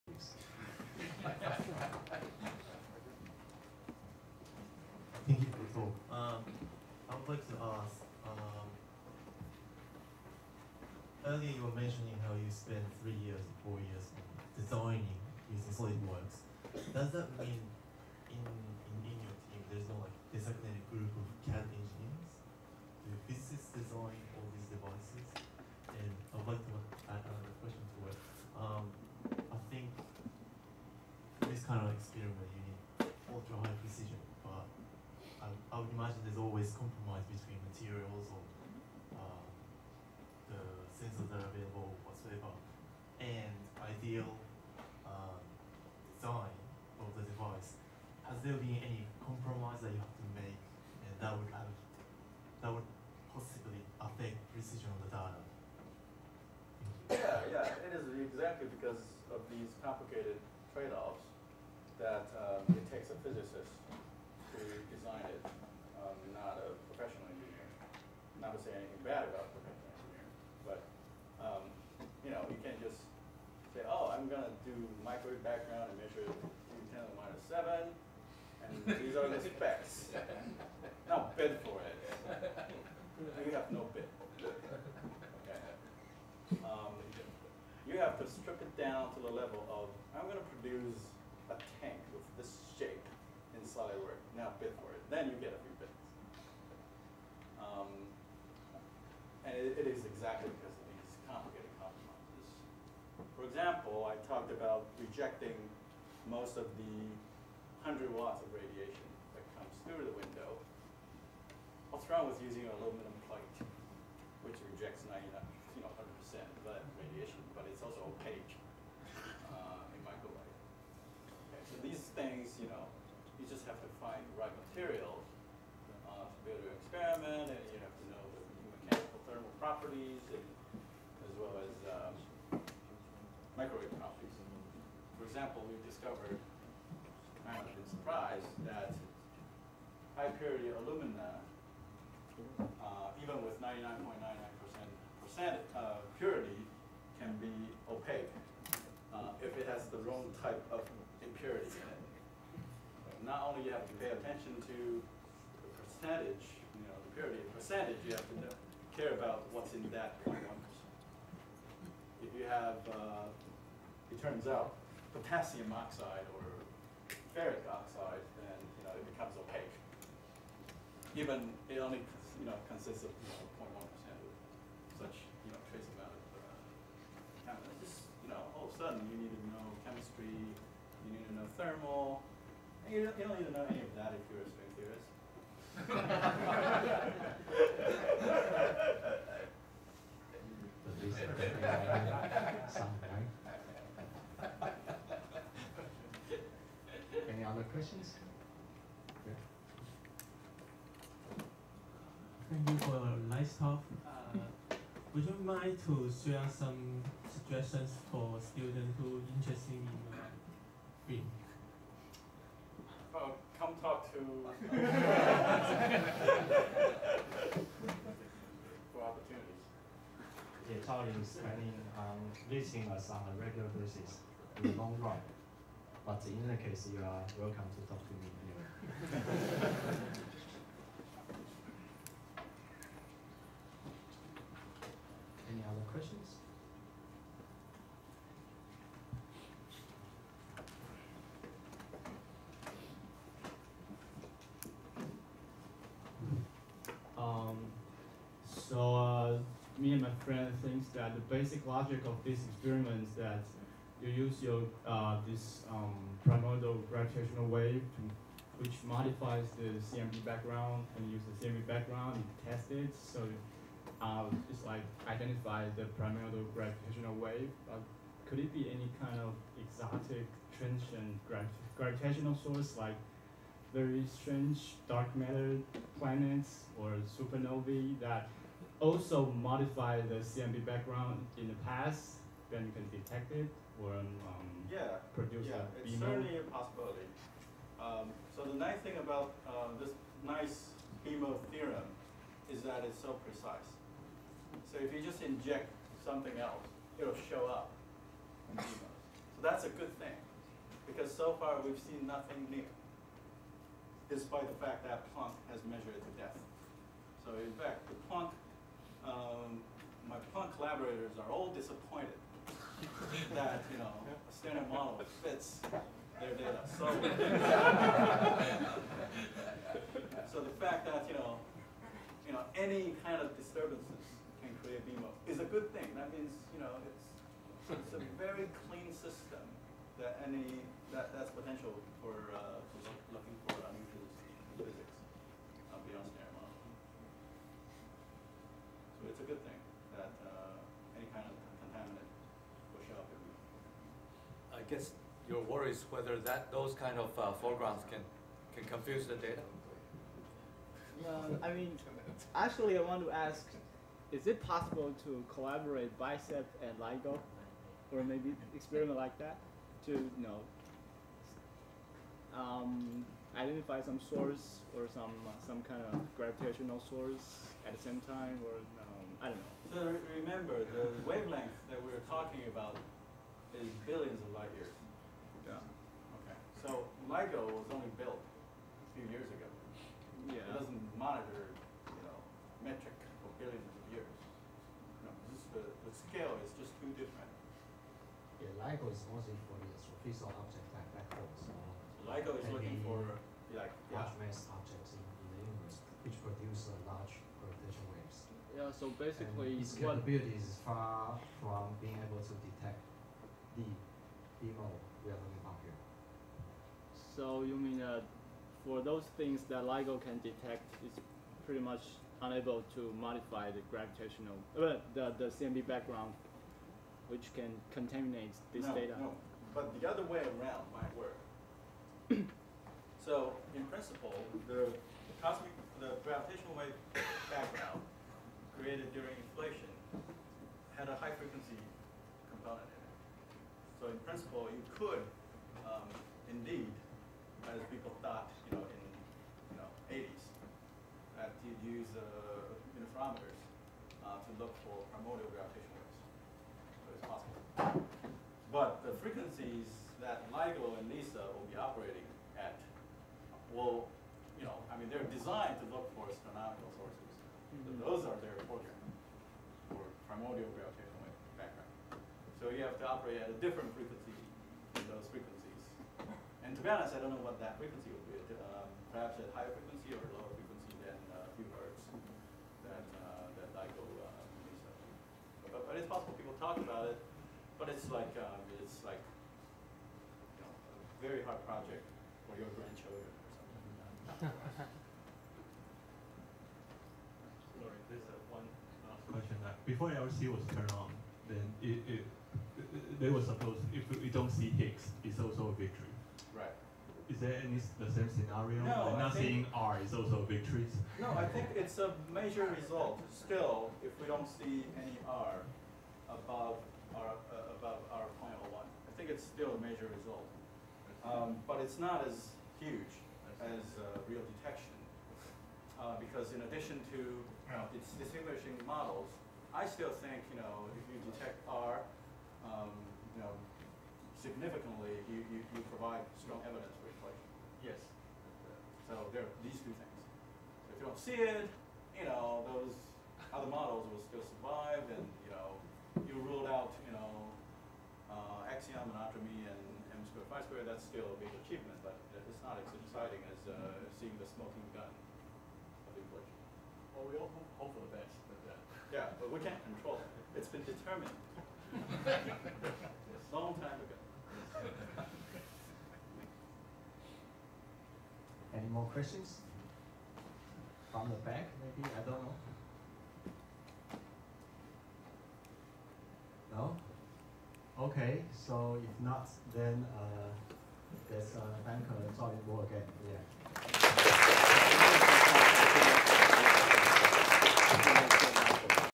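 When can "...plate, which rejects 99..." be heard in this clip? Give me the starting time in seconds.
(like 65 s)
113 s.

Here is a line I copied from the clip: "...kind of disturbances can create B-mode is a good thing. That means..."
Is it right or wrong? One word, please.
right.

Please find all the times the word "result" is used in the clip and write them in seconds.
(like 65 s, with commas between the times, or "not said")
502 s, 509 s.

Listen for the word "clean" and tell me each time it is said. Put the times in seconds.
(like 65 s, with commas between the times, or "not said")
328 s.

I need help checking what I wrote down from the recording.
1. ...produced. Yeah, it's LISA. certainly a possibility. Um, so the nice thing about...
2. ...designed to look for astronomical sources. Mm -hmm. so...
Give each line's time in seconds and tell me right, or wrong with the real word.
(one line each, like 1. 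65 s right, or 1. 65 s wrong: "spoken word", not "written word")
1. 285 s wrong: "BMO", not "LISA"
2. 455 s right.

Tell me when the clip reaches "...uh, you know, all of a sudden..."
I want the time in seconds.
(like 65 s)
177 s.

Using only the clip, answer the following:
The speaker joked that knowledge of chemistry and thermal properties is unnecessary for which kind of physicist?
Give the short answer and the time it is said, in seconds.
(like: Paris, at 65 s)
string theorist, at 184 s.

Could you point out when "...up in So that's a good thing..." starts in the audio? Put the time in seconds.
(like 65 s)
297 s.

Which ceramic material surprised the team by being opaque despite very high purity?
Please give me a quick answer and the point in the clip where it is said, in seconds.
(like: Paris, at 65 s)
high purity alumina, at 140 s.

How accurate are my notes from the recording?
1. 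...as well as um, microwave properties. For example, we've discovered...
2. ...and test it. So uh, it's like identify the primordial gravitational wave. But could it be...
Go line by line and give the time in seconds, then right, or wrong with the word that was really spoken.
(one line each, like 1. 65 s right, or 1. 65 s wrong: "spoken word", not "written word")
1. 131 s right
2. 262 s right.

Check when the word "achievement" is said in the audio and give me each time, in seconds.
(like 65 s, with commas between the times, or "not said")
541 s.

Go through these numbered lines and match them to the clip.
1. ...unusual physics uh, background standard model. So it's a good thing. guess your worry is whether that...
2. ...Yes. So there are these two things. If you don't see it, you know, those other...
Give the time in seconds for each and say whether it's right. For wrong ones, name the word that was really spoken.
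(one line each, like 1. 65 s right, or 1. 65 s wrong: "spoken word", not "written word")
1. 333 s wrong: "beyond", not "background"
2. 527 s right.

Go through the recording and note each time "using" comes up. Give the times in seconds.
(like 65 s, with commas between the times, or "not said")
15 s, 112 s.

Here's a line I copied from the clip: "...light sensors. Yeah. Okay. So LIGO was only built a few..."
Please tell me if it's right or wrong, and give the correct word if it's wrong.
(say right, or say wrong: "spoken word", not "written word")
wrong: "years", not "sensors".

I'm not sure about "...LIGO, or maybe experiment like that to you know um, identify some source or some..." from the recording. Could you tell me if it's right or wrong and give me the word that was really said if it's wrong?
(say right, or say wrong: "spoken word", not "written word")
right.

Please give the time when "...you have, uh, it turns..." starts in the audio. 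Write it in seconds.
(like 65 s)
162 s.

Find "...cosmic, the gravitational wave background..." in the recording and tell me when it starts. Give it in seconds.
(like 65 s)
425 s.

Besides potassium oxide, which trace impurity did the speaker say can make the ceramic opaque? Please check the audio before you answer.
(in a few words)
ferric oxide.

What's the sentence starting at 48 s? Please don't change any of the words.
Has there been any compromise that you have to make and that would have that would possibly affect precision of the data?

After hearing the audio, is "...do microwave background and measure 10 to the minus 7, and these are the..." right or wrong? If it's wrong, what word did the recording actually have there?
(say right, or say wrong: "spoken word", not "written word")
right.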